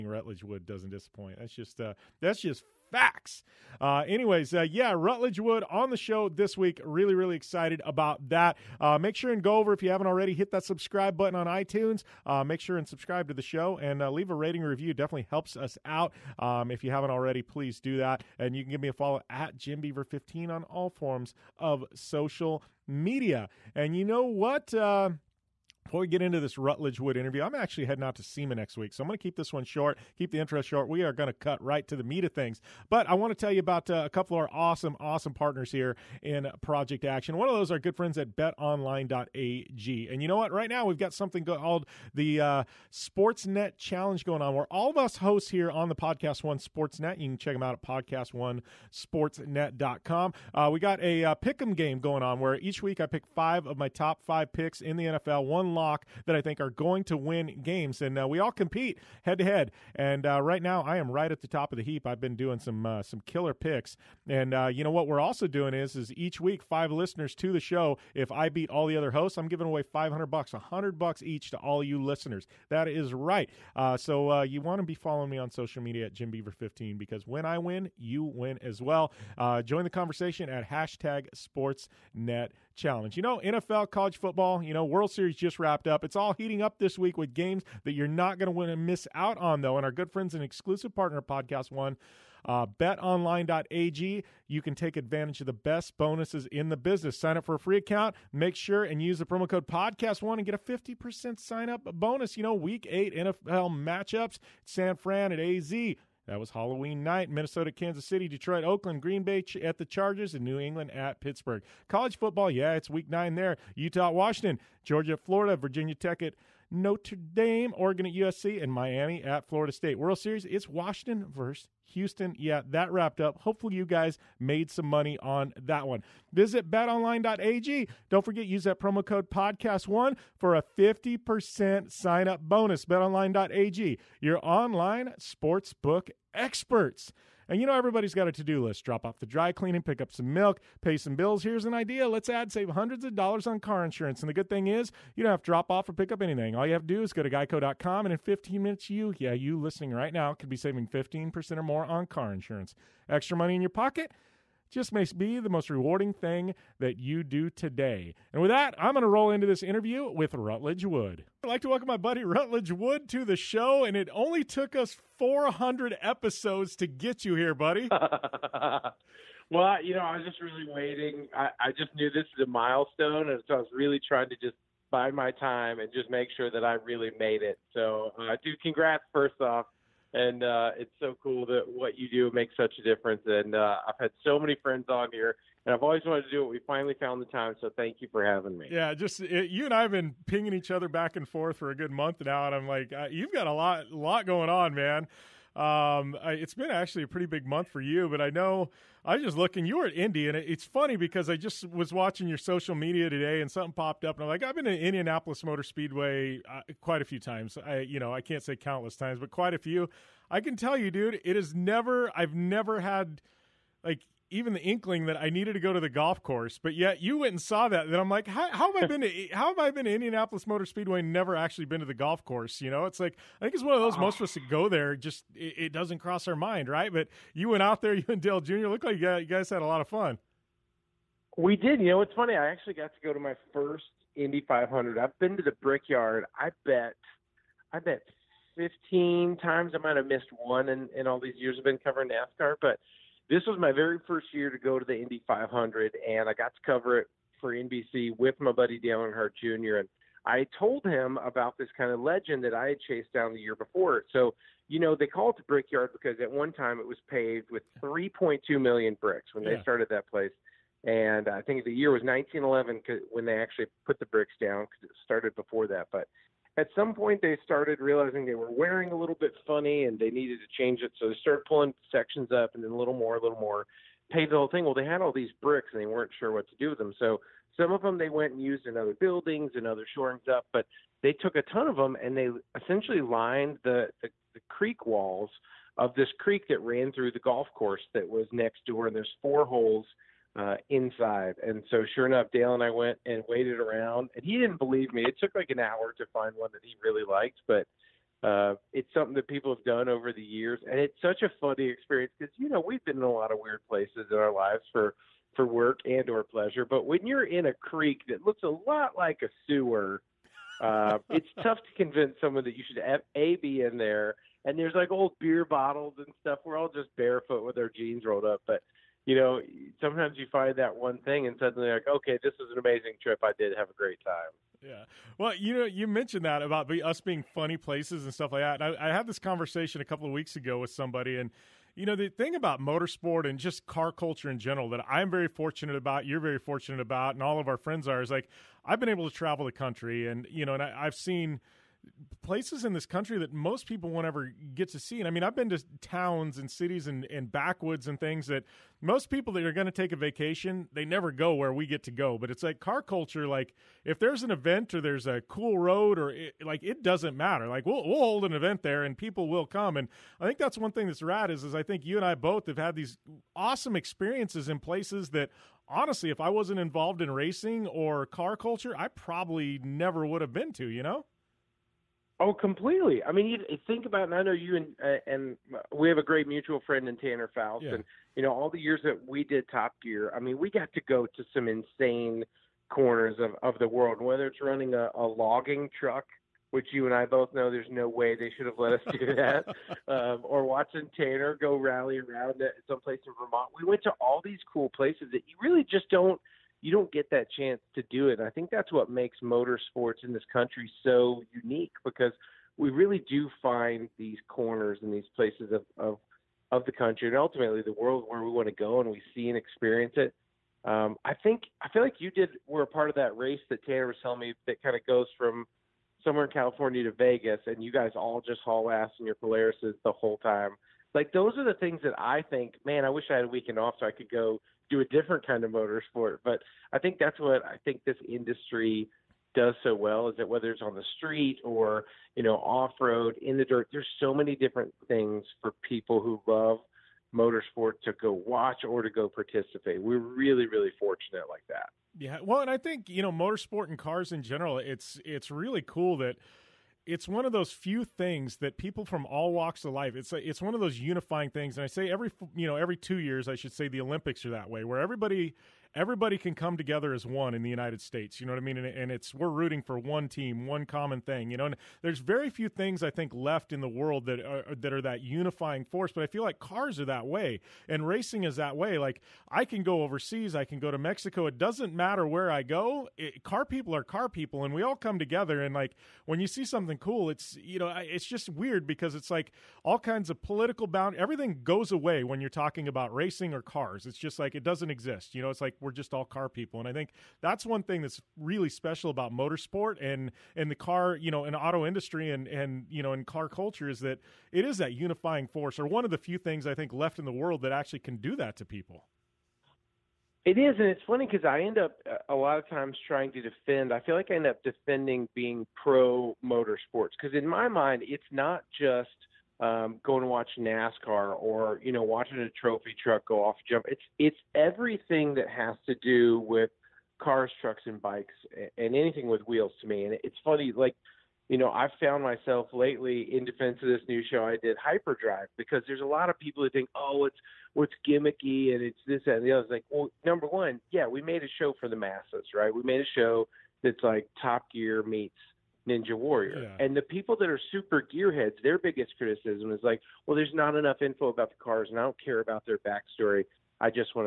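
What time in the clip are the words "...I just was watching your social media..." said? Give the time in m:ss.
3:21.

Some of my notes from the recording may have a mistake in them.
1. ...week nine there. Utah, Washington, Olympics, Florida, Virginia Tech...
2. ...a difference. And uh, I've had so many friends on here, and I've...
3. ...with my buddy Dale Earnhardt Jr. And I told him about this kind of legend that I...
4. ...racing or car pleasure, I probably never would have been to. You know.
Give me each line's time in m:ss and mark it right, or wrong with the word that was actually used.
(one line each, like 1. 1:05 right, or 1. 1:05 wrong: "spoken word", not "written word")
1. 1:52 wrong: "Georgia", not "Olympics"
2. 3:02 right
3. 4:08 right
4. 6:07 wrong: "culture", not "pleasure".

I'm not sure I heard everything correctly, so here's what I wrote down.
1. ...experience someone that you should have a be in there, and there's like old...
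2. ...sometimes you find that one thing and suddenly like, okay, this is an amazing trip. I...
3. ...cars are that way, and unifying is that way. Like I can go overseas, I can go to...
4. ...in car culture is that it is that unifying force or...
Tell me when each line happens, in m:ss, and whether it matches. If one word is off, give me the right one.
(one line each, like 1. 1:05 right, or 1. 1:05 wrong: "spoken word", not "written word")
1. 5:11 wrong: "convince", not "experience"
2. 5:19 right
3. 7:46 wrong: "racing", not "unifying"
4. 8:12 right.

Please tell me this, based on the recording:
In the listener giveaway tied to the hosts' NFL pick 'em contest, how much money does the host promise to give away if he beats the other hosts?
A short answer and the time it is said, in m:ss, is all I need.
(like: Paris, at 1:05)
$500, at 1:09.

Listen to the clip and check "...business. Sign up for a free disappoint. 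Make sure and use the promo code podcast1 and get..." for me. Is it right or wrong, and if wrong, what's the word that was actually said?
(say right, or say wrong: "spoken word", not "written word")
wrong: "account", not "disappoint".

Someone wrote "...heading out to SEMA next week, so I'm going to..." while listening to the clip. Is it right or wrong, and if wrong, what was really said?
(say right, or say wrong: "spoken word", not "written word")
right.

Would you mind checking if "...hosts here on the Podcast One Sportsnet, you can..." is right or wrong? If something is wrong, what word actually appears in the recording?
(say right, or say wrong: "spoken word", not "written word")
right.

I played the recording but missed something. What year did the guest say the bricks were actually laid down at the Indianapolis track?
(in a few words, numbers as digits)
1911.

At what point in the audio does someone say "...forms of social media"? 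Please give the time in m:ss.
0:20.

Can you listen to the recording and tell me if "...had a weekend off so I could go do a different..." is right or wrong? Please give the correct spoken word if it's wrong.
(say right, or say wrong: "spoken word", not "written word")
right.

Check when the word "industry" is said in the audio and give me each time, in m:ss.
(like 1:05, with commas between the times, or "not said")
7:08, 8:11.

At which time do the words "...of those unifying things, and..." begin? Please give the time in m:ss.
7:30.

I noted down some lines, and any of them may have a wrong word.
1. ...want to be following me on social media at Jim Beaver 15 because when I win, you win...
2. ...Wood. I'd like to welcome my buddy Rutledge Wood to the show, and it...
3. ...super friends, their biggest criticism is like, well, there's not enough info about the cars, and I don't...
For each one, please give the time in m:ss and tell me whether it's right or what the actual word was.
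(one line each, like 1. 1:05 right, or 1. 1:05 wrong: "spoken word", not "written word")
1. 1:14 right
2. 2:40 right
3. 8:57 wrong: "gearheads", not "friends".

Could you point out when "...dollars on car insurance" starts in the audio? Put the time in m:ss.
2:23.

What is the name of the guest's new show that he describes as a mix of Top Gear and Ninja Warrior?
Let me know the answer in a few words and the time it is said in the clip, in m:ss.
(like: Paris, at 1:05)
Hyperdrive, at 8:44.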